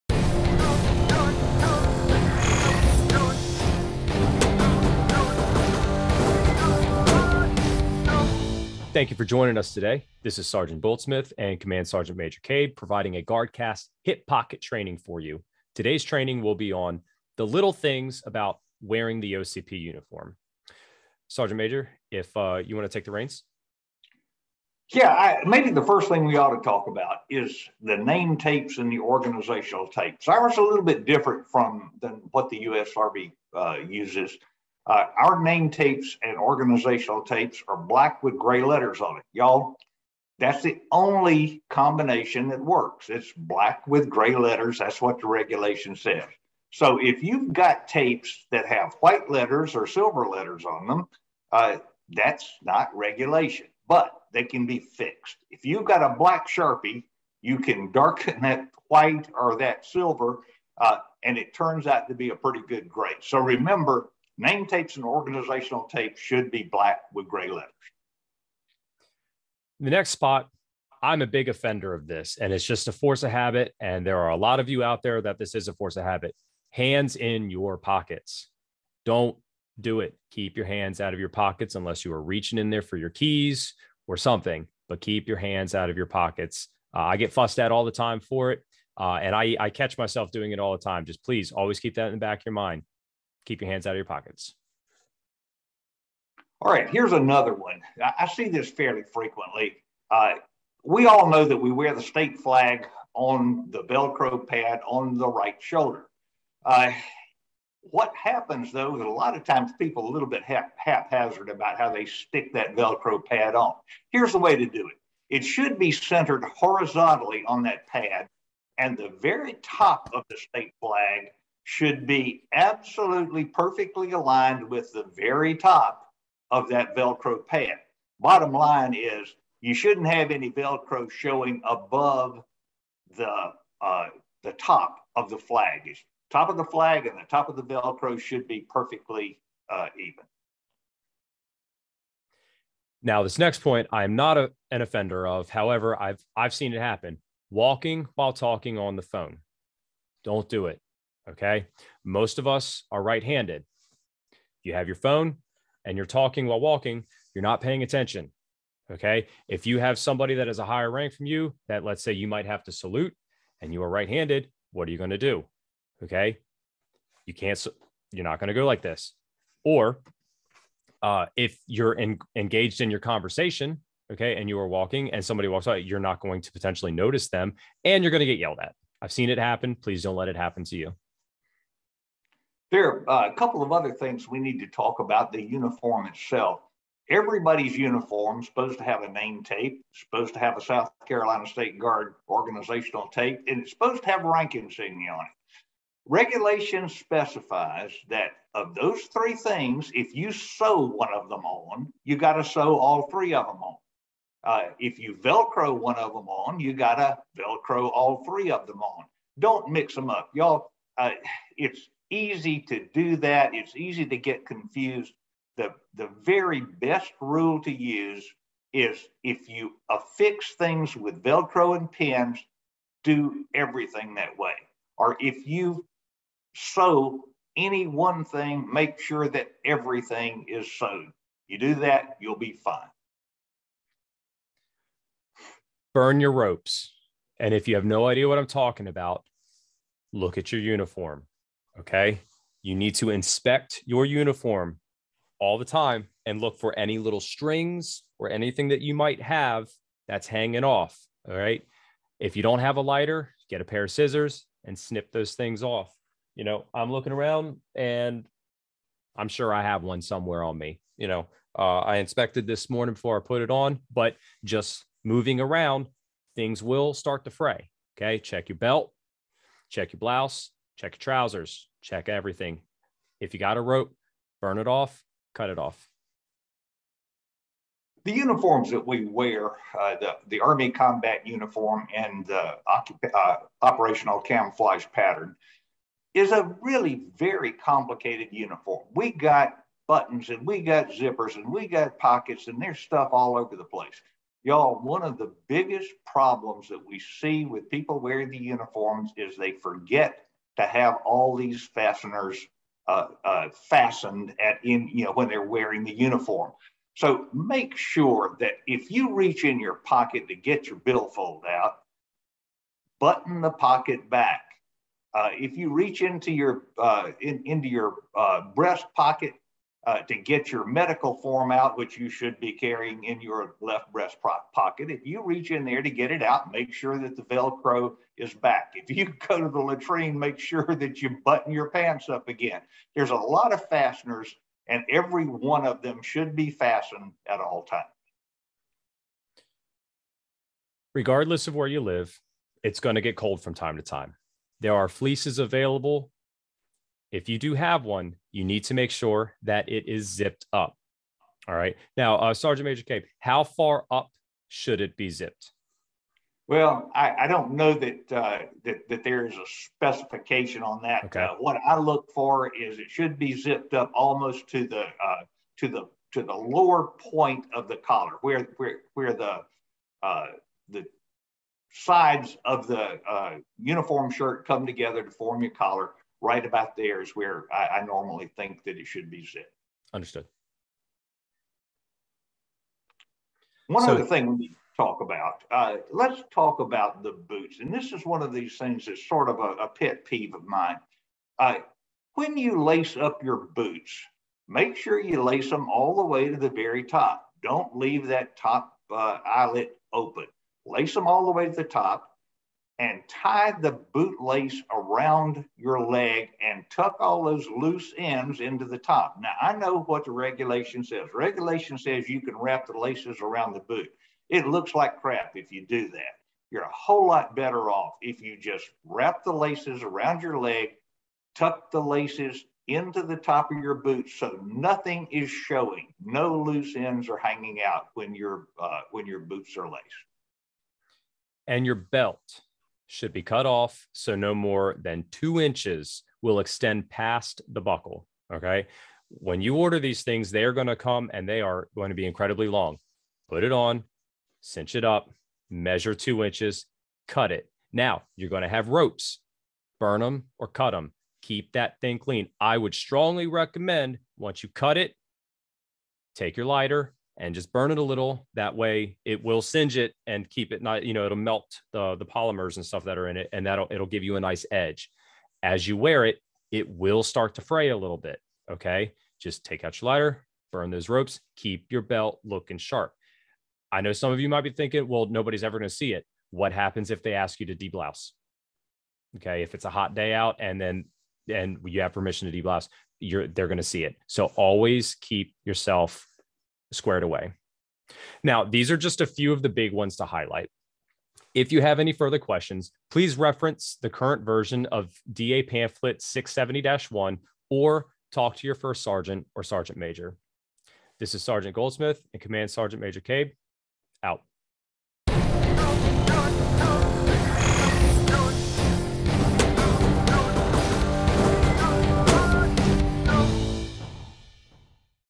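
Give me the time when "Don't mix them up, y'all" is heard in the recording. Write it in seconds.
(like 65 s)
209 s.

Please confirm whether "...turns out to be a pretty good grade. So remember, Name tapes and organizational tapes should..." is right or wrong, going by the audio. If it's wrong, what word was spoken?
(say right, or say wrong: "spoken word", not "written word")
right.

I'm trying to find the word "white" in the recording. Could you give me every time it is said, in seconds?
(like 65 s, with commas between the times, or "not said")
48 s, 58 s.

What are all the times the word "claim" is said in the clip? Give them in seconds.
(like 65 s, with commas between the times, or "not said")
not said.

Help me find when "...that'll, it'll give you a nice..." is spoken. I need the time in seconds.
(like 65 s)
463 s.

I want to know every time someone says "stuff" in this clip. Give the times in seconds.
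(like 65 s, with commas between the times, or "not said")
292 s, 462 s.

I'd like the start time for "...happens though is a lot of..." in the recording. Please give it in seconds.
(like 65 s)
108 s.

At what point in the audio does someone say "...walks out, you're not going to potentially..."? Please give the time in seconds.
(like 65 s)
175 s.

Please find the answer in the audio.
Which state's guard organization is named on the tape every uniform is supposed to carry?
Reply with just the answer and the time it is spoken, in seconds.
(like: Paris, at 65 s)
South Carolina, at 190 s.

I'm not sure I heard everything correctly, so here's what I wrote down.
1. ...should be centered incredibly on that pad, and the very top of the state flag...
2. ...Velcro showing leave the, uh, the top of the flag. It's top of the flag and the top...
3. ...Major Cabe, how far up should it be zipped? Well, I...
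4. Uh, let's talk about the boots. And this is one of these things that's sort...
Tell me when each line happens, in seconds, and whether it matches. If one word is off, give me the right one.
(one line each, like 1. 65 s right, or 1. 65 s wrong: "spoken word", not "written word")
1. 115 s wrong: "horizontally", not "incredibly"
2. 130 s wrong: "above", not "leave"
3. 352 s right
4. 385 s right.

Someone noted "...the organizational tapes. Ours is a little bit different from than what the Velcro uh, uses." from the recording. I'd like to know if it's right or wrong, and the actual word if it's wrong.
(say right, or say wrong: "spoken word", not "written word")
wrong: "USRB", not "Velcro".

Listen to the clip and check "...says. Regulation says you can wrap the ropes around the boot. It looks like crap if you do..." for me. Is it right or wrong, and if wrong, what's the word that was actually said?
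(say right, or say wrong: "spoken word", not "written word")
wrong: "laces", not "ropes".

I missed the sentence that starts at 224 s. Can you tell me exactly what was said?
Or if you sew any one thing, make sure that everything is sewn.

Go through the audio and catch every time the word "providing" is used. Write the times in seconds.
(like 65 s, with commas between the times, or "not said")
12 s.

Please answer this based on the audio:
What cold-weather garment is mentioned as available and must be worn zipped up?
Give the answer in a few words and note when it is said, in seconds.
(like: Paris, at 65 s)
fleeces, at 344 s.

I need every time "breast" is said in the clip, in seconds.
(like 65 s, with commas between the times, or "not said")
318 s, 323 s.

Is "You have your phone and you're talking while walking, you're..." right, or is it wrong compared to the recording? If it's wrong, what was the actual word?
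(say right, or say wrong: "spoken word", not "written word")
right.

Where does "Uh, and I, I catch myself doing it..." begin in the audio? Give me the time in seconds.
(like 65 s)
88 s.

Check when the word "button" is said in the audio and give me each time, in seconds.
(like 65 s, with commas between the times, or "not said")
289 s, 312 s, 331 s.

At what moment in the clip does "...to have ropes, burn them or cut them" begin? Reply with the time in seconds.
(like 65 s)
448 s.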